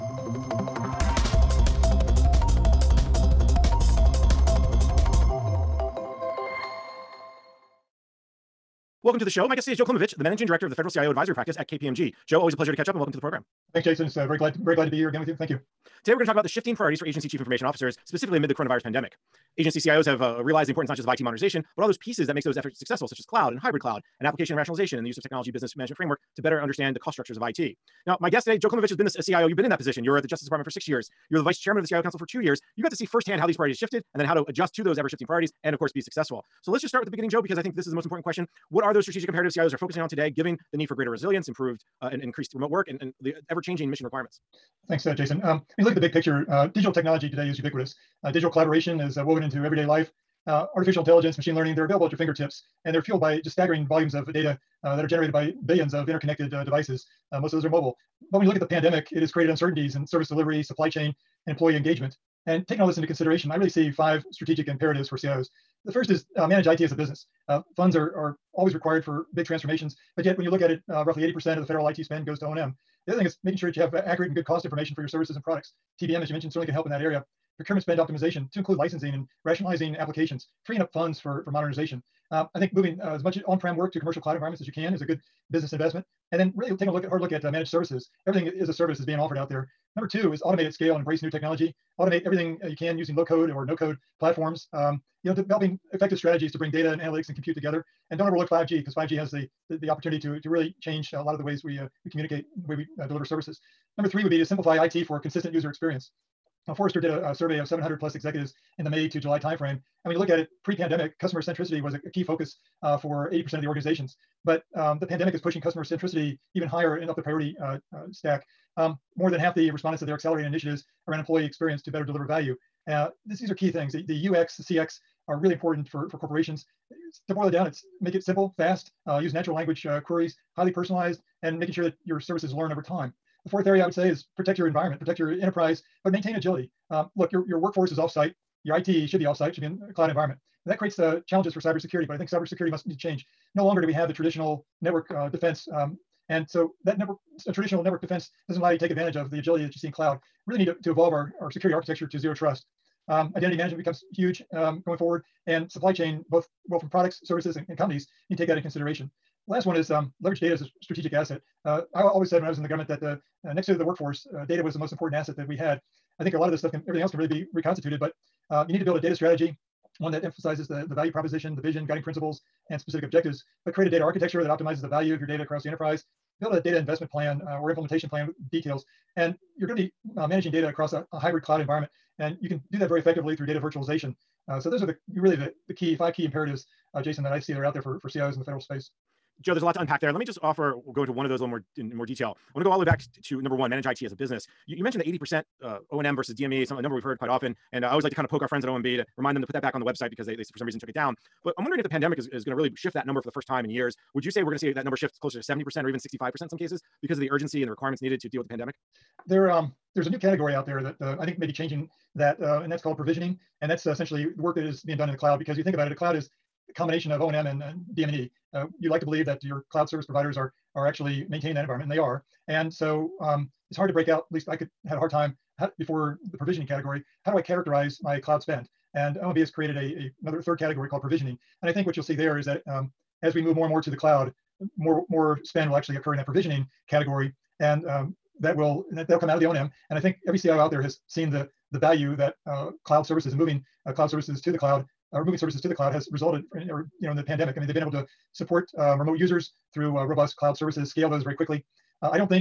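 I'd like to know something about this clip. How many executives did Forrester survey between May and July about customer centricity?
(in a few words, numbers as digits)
700 plus.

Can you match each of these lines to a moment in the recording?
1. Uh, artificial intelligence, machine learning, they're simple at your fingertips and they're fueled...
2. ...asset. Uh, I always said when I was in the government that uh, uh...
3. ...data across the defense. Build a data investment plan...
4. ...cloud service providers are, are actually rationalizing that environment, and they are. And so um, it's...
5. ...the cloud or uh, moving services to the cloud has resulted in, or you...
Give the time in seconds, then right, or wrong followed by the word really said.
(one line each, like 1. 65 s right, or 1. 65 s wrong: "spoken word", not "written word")
1. 50 s wrong: "available", not "simple"
2. 161 s right
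3. 175 s wrong: "enterprise", not "defense"
4. 219 s wrong: "maintaining", not "rationalizing"
5. 244 s right.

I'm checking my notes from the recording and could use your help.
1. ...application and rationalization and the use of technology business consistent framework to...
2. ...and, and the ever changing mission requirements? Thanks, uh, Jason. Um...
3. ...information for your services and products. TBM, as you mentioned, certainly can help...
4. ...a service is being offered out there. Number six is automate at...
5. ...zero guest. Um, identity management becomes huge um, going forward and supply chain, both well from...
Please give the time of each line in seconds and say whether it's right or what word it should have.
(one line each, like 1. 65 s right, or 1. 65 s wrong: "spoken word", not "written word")
1. 24 s wrong: "management", not "consistent"
2. 42 s right
3. 74 s right
4. 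88 s wrong: "two", not "six"
5. 152 s wrong: "trust", not "guest".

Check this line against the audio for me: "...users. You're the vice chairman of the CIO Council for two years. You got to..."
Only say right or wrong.
wrong.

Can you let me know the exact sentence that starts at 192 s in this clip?
I want to go all the way back to number one, manage IT as a business.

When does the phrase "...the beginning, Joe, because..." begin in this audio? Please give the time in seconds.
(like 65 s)
37 s.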